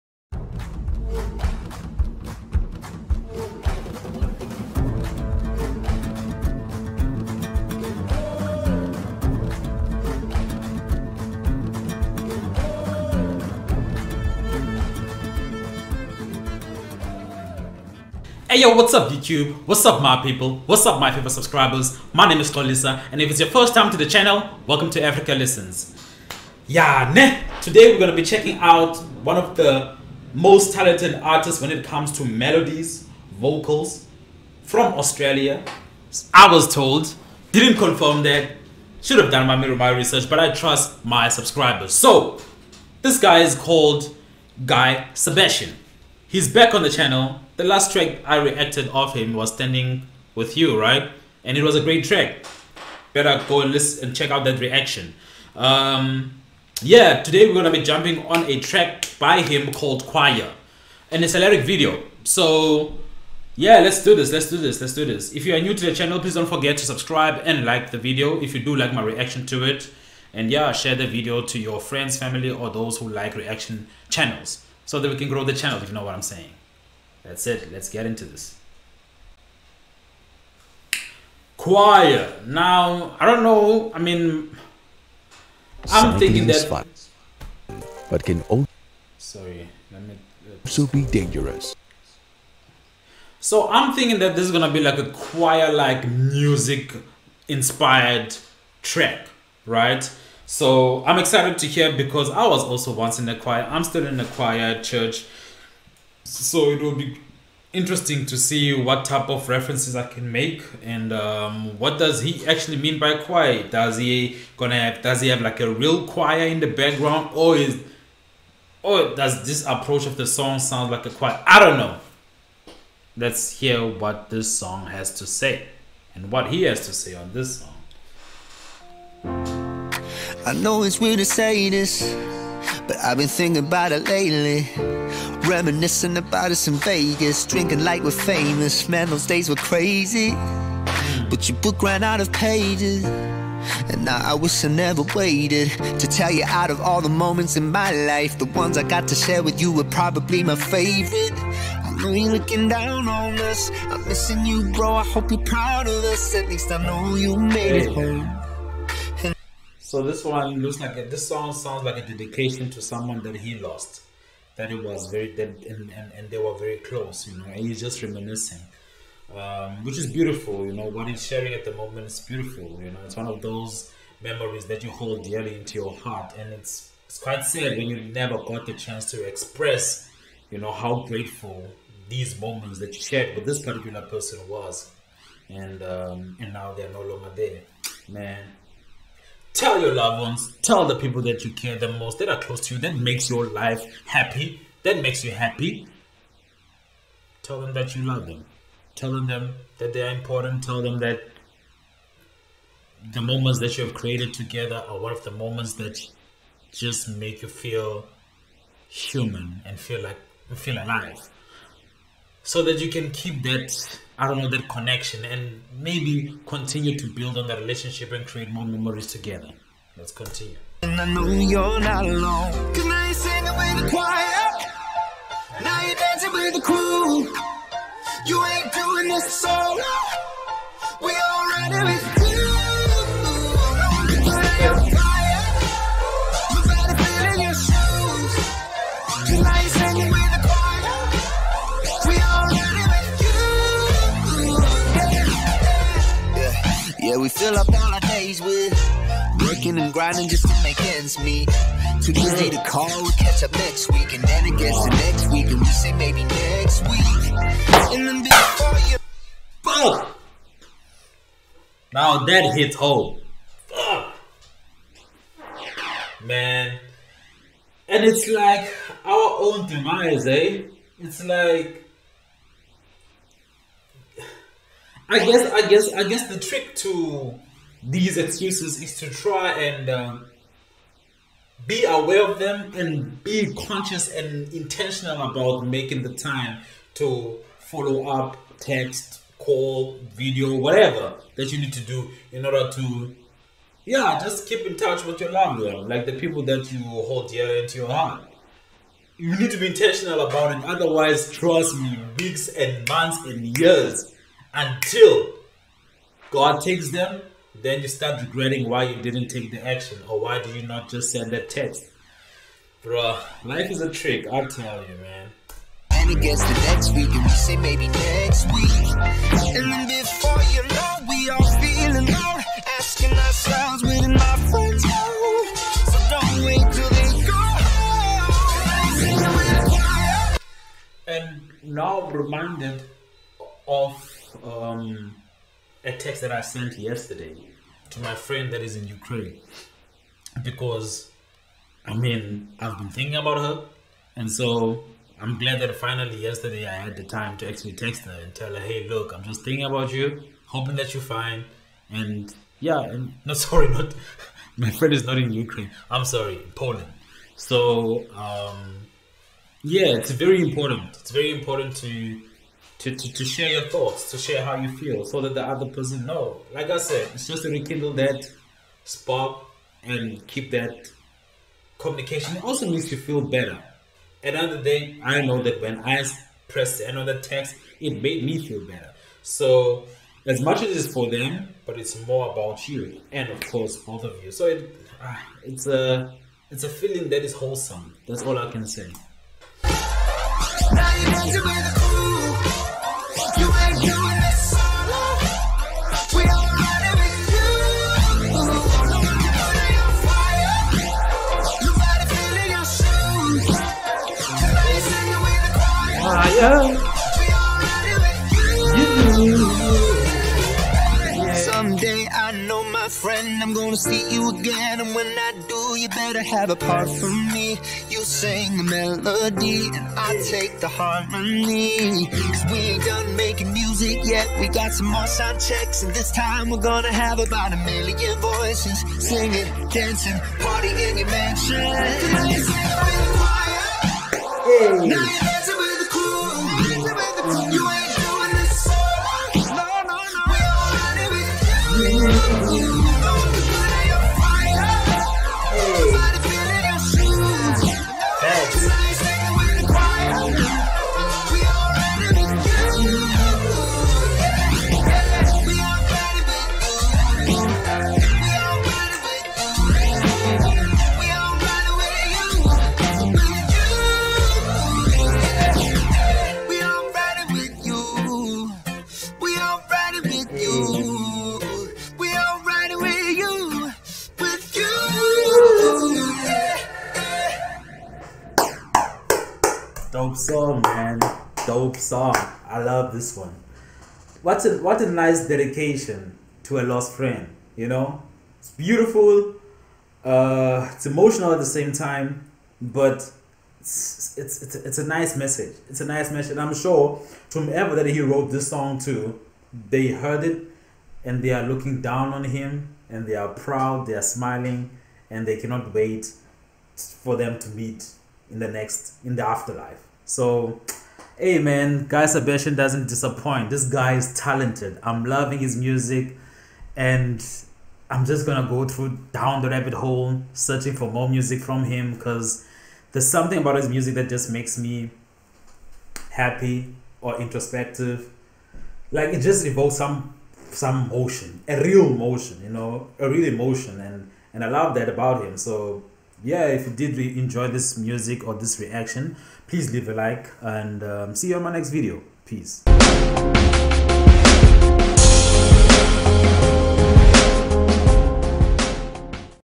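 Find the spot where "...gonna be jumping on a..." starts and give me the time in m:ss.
0:57.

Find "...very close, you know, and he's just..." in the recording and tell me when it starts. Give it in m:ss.
2:46.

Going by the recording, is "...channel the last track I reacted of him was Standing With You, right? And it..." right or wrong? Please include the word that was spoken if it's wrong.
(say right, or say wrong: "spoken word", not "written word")
right.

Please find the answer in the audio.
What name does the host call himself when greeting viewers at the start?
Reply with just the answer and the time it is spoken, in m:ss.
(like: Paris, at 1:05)
Tolisa, at 0:22.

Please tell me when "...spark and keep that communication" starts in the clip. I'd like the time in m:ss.
6:08.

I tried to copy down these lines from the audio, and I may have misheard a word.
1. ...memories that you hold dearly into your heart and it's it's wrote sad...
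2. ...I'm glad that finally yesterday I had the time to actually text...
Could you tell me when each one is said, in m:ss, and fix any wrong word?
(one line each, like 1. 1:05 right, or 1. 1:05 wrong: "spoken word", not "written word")
1. 2:54 wrong: "quite", not "wrote"
2. 5:45 right.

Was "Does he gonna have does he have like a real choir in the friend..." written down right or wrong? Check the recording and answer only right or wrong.
wrong.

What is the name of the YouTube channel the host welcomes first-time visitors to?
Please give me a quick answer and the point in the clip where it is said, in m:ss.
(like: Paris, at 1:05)
Africa Listens, at 0:25.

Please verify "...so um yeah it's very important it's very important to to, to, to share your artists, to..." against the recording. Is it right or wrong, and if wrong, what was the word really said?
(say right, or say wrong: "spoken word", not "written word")
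wrong: "thoughts", not "artists".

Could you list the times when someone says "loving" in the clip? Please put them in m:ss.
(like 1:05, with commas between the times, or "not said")
8:35.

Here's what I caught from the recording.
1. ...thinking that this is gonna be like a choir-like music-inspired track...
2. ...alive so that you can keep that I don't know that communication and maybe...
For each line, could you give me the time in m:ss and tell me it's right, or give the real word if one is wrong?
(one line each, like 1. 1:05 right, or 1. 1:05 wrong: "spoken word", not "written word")
1. 1:33 right
2. 3:30 wrong: "connection", not "communication".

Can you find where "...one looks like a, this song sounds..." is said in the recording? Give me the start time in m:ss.
2:40.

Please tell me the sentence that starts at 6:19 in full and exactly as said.
So as much as it's for them, but it's more about you and of course both of you.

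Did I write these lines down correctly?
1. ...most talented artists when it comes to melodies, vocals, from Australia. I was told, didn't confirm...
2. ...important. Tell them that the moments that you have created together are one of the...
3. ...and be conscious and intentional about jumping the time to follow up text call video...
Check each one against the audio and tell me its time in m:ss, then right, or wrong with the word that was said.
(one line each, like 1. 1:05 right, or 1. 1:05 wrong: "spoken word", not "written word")
1. 0:30 right
2. 3:20 right
3. 4:42 wrong: "making", not "jumping".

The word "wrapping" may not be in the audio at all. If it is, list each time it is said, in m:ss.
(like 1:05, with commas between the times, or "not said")
not said.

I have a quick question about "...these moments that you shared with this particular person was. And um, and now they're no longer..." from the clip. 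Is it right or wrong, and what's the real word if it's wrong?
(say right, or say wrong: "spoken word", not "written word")
right.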